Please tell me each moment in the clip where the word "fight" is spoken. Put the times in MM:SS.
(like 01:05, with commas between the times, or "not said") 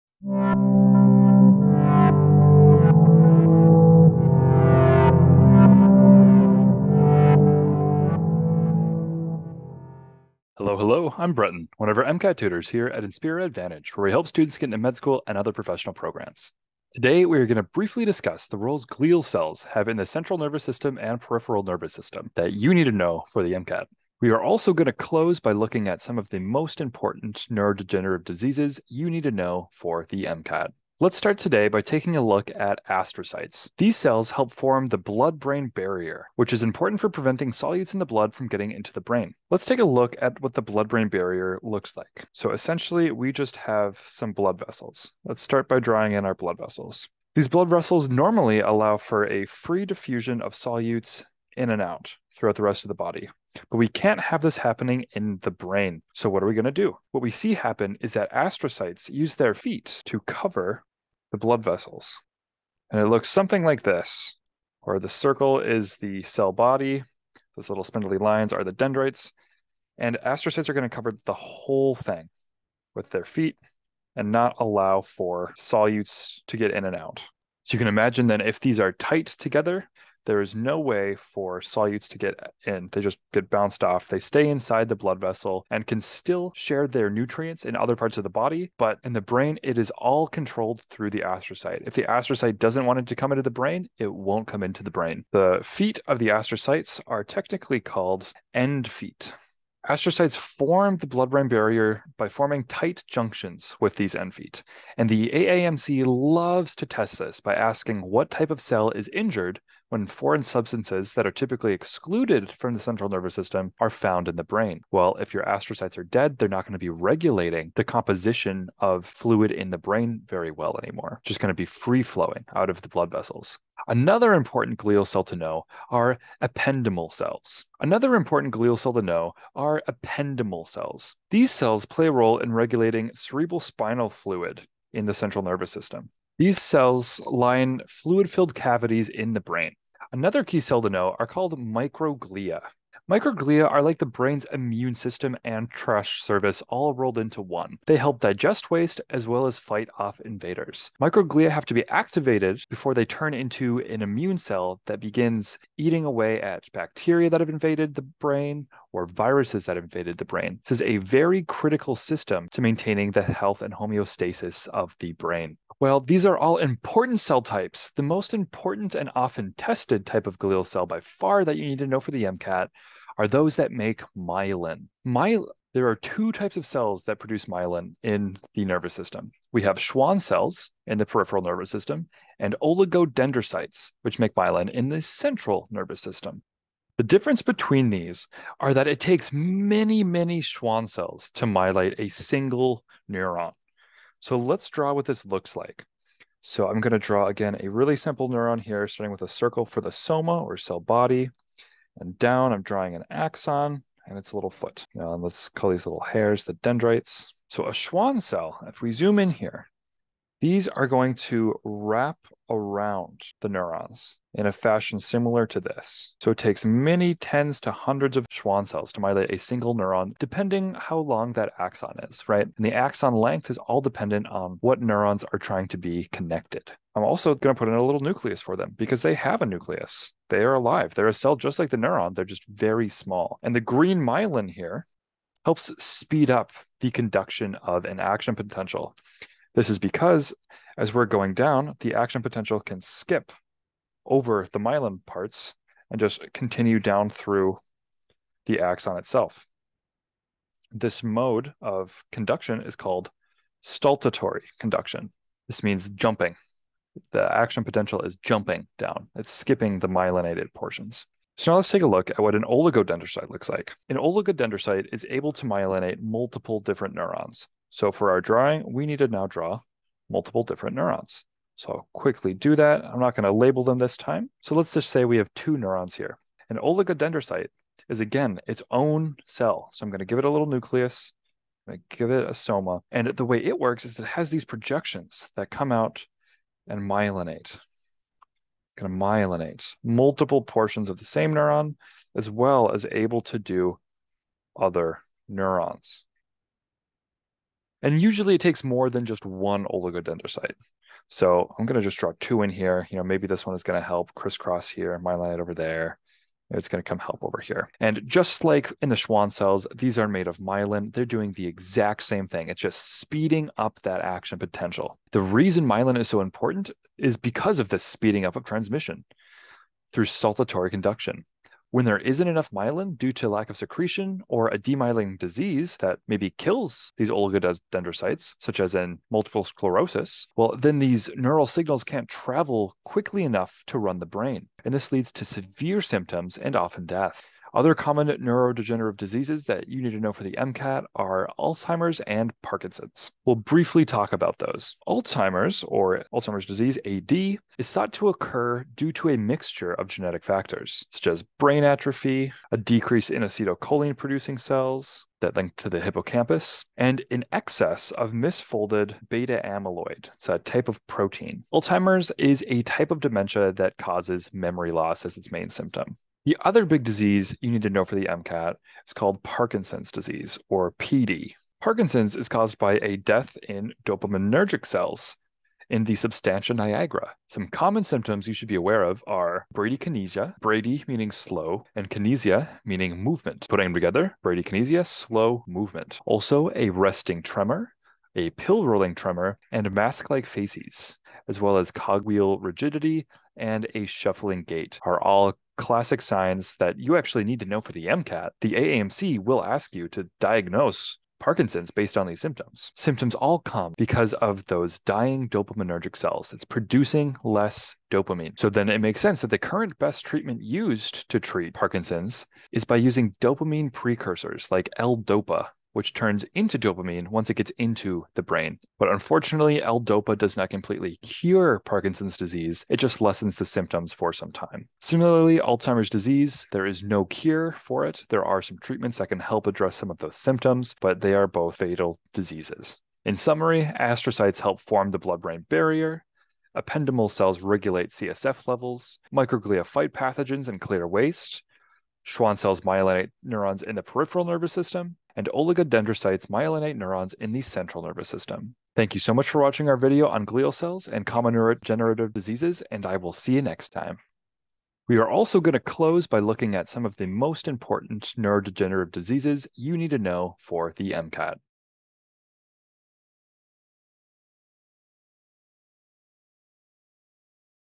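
02:29, 07:19.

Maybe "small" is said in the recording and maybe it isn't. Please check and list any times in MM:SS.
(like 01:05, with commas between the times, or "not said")
03:52.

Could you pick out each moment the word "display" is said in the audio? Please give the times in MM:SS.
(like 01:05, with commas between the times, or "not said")
not said.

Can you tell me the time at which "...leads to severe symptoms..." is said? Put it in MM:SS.
05:34.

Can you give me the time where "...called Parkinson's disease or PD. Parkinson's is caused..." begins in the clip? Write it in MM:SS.
06:08.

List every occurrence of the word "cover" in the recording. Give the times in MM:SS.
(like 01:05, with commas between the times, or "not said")
01:00, 01:10.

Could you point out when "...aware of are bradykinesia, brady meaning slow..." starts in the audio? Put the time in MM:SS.
06:18.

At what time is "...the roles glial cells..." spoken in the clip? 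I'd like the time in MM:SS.
00:18.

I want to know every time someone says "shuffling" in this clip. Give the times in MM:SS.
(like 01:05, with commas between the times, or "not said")
06:33.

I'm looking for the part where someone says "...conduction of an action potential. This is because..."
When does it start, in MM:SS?
03:56.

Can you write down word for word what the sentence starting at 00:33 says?
These cells help form the blood brain barrier, which is important for preventing solutes in the blood from getting into the brain.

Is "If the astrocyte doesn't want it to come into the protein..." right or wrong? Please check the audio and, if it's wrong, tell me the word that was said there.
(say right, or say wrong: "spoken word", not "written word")
wrong: "brain", not "protein".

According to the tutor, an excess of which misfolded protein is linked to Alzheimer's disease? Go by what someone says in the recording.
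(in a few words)
Beta amyloid.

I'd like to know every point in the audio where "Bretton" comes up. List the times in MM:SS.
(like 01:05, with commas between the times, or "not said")
00:11.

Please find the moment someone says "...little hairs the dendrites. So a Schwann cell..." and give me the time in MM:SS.
03:25.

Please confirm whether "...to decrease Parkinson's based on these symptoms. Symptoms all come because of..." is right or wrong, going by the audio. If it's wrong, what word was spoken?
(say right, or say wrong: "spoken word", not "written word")
wrong: "diagnose", not "decrease".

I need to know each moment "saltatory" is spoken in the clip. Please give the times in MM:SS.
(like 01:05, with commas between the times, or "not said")
04:13, 05:20.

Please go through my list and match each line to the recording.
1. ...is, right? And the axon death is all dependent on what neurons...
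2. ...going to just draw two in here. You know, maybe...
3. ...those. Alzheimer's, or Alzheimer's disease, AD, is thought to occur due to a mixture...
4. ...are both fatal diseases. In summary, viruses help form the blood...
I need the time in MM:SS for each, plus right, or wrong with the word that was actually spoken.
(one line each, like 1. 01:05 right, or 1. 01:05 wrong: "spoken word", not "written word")
1. 03:42 wrong: "length", not "death"
2. 05:01 right
3. 05:44 right
4. 07:11 wrong: "astrocytes", not "viruses".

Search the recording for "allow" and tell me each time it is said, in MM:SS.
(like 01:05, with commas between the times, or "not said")
00:48, 01:14.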